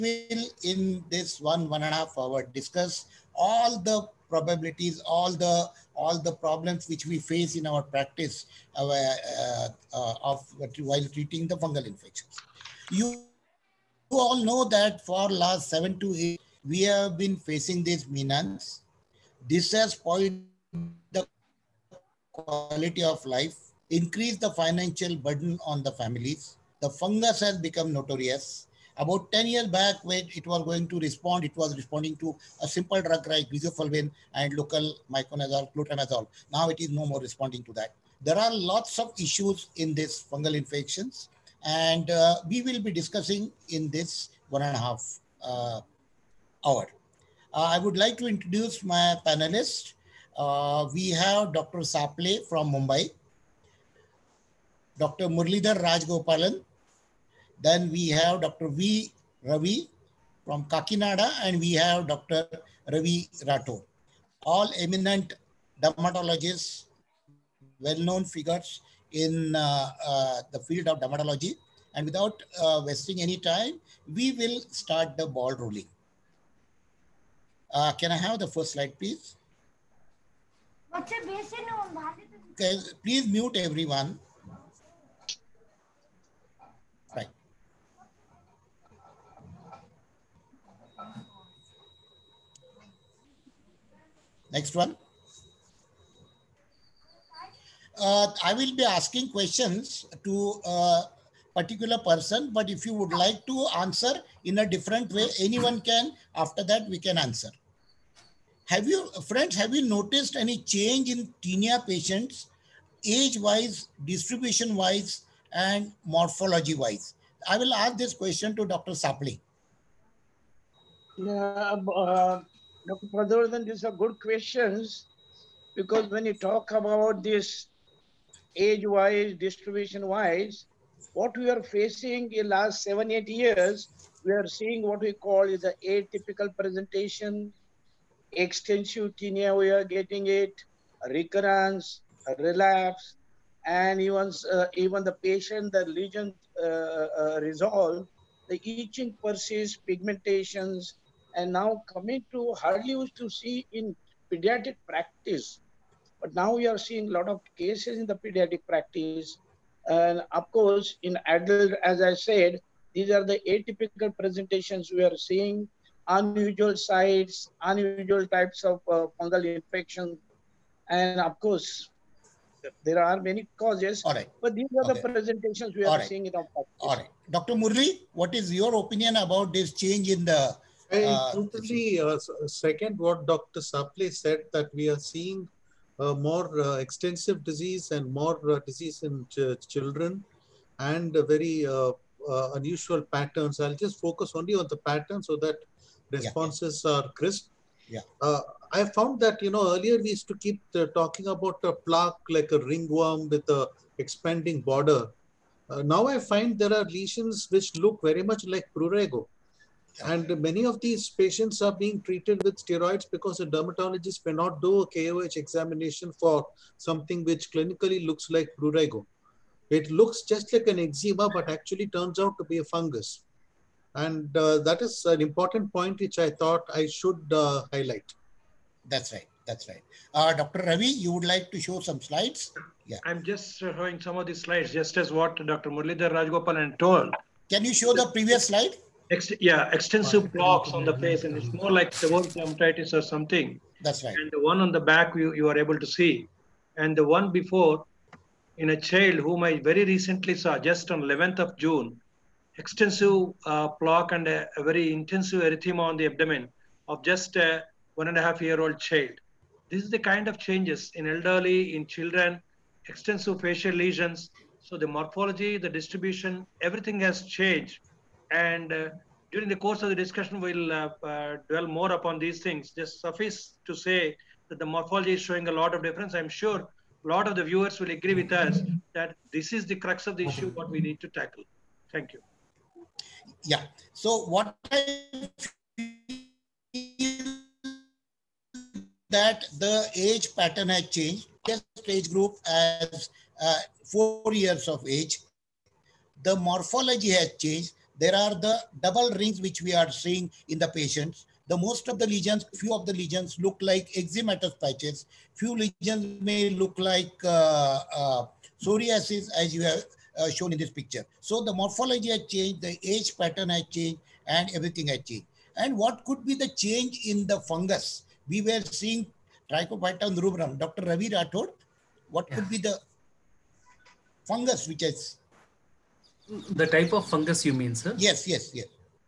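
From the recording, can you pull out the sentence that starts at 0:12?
You, you all know that for last seven to eight, we have been facing these menas.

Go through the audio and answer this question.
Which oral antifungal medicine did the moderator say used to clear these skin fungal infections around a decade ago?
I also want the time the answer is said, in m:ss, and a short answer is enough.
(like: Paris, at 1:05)
griseofulvin, at 0:33.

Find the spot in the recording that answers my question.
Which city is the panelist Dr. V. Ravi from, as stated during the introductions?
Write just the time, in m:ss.
1:00.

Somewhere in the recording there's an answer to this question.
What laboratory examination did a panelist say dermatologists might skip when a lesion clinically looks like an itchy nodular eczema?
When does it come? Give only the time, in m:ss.
3:34.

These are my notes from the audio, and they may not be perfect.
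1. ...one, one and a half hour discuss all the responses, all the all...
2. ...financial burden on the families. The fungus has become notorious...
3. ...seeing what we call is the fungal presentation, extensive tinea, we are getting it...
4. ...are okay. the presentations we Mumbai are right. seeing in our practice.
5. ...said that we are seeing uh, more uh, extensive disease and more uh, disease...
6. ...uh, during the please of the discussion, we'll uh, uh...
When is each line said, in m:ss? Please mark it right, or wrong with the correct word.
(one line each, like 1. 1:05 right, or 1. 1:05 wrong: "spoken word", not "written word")
1. 0:01 wrong: "probabilities", not "responses"
2. 0:24 right
3. 2:14 wrong: "atypical", not "fungal"
4. 2:54 wrong: "All", not "Mumbai"
5. 3:04 right
6. 4:28 wrong: "course", not "please".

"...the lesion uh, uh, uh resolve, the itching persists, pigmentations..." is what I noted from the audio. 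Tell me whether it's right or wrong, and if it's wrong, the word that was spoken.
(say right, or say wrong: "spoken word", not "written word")
right.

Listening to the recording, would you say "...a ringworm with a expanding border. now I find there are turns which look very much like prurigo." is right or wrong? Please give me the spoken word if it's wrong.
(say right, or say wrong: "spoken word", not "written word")
wrong: "lesions", not "turns".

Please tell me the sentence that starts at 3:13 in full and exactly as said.
I'll just focus only on the pattern so that responses yeah.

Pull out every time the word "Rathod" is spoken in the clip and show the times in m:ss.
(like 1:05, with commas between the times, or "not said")
1:03, 5:21.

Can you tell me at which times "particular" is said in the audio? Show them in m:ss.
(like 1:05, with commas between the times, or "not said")
1:41.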